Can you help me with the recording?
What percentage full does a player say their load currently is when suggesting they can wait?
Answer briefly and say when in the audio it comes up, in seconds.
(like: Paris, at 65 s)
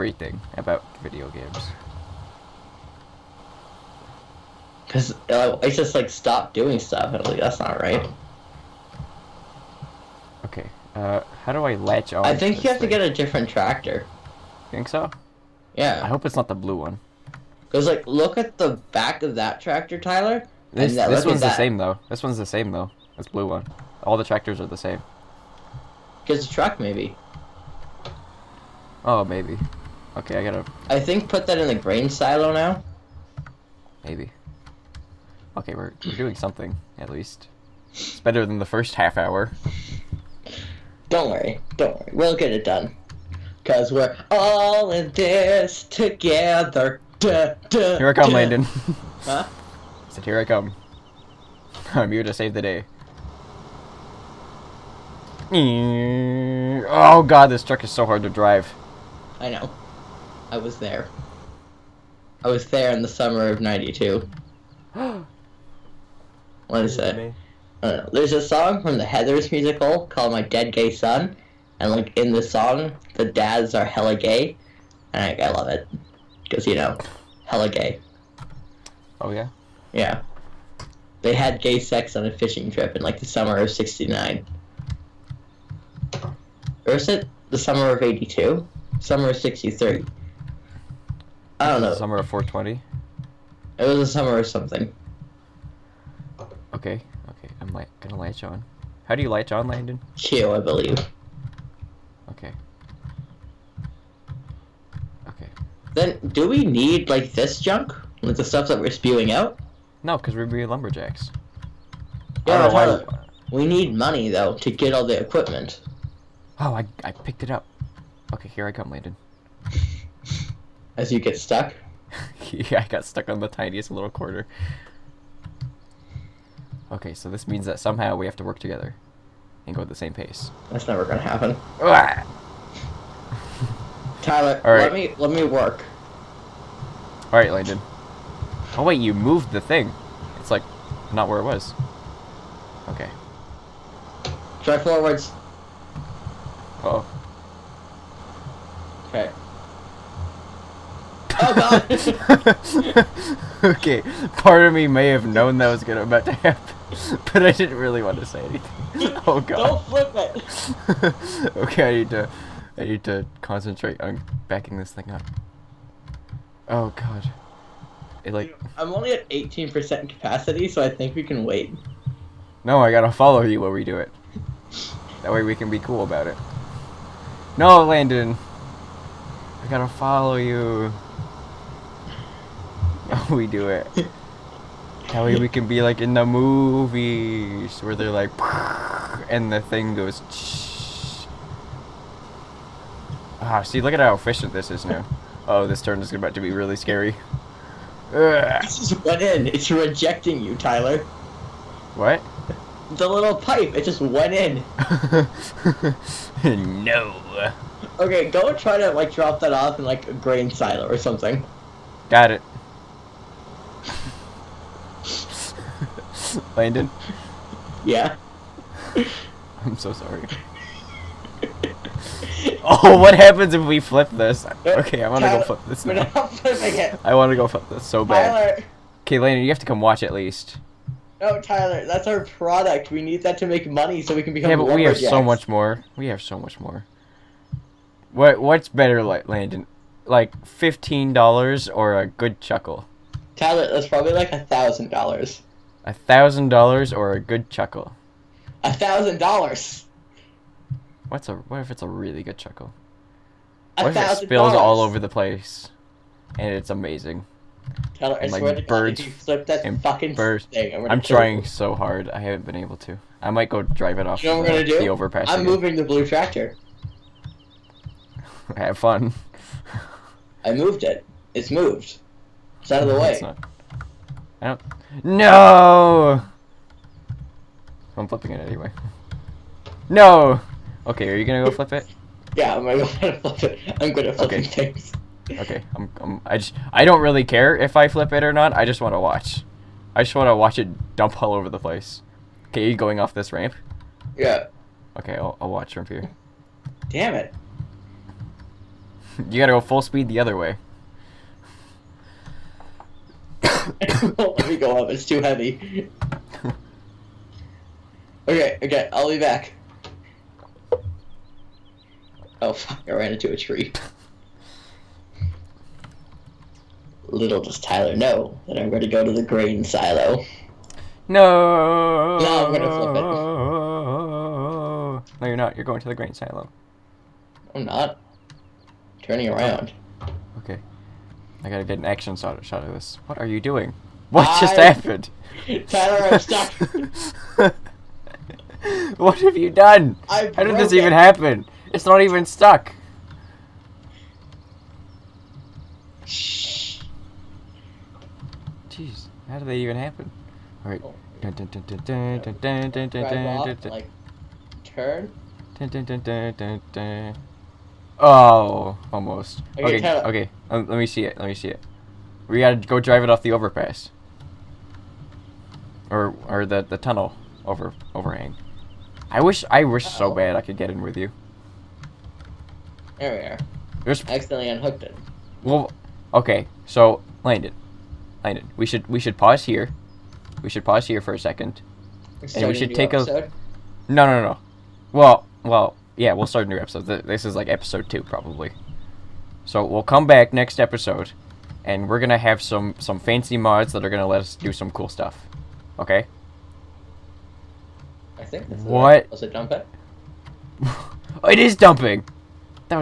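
18%, at 169 s.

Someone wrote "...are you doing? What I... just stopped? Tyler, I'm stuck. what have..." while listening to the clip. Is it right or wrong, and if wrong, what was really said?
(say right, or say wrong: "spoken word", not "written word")
wrong: "happened", not "stopped".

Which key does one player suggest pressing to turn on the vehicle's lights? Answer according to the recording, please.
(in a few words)
Q.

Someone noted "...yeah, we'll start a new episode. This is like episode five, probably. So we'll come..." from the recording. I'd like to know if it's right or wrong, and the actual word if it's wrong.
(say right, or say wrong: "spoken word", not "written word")
wrong: "two", not "five".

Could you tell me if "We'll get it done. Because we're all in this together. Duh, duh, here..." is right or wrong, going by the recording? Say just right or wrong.
right.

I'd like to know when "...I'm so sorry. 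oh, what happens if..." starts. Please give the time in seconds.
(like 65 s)
219 s.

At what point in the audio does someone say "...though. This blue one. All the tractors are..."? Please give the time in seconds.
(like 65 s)
22 s.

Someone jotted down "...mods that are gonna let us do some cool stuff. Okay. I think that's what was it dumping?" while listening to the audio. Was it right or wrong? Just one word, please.
right.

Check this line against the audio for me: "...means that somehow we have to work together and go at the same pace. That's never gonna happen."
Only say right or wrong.
right.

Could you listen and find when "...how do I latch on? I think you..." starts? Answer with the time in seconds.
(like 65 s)
11 s.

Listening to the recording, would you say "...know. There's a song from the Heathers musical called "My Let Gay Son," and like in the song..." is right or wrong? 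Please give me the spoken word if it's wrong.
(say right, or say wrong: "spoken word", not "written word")
wrong: "Dead", not "Let".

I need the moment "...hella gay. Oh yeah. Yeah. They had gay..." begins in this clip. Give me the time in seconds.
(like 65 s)
77 s.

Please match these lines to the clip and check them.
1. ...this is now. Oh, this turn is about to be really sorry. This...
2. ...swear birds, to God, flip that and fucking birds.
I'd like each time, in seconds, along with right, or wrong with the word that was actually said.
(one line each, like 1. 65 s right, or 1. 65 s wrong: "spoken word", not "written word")
1. 194 s wrong: "scary", not "sorry"
2. 258 s right.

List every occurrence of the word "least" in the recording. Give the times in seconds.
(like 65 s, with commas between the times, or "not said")
37 s, 230 s.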